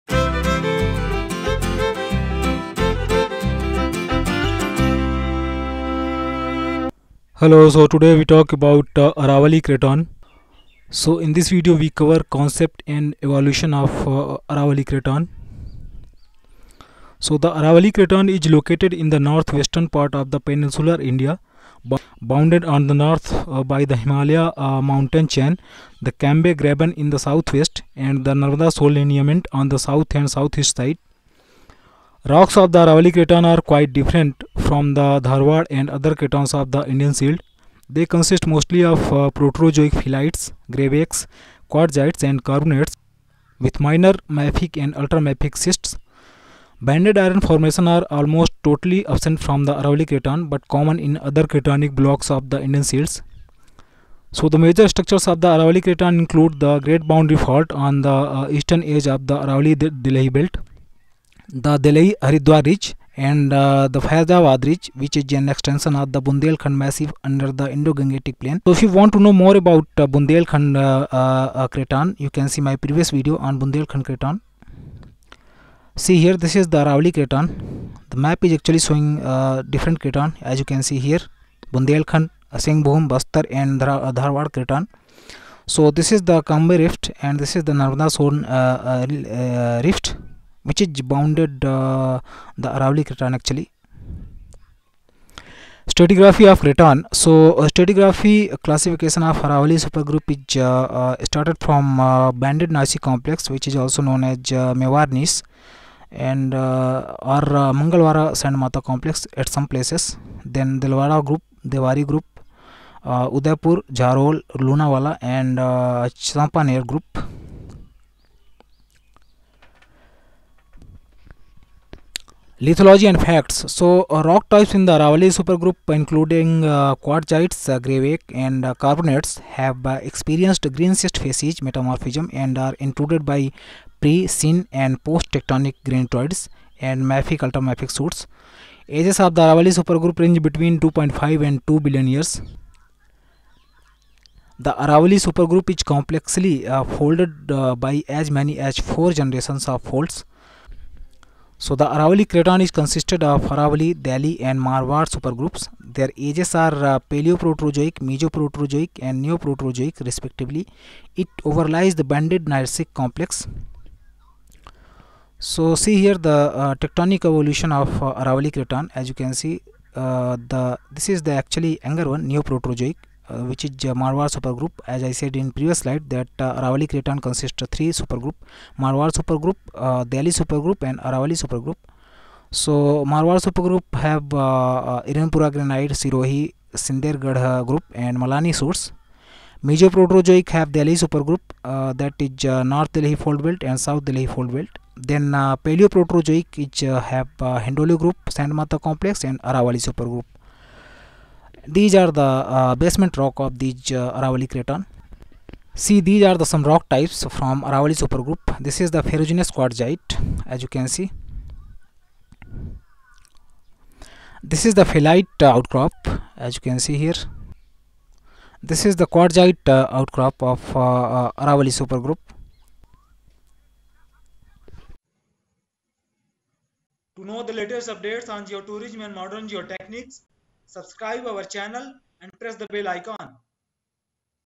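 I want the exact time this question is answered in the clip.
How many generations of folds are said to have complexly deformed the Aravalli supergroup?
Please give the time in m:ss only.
2:28.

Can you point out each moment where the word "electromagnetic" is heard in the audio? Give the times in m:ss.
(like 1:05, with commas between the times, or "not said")
not said.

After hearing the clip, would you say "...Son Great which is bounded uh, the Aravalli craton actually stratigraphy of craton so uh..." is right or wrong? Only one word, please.
wrong.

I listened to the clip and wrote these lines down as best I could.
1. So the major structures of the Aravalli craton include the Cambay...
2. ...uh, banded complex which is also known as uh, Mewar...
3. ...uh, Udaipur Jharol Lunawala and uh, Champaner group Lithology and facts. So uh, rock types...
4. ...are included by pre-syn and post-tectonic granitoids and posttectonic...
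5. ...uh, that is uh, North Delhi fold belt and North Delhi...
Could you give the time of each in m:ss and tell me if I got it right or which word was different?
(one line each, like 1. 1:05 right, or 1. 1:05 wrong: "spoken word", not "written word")
1. 0:54 wrong: "Great", not "Cambay"
2. 1:41 right
3. 1:53 right
4. 2:12 wrong: "mafic", not "posttectonic"
5. 3:11 wrong: "South", not "North".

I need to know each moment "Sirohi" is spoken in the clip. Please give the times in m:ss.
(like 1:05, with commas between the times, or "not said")
3:05.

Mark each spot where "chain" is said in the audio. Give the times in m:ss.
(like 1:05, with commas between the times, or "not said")
0:25.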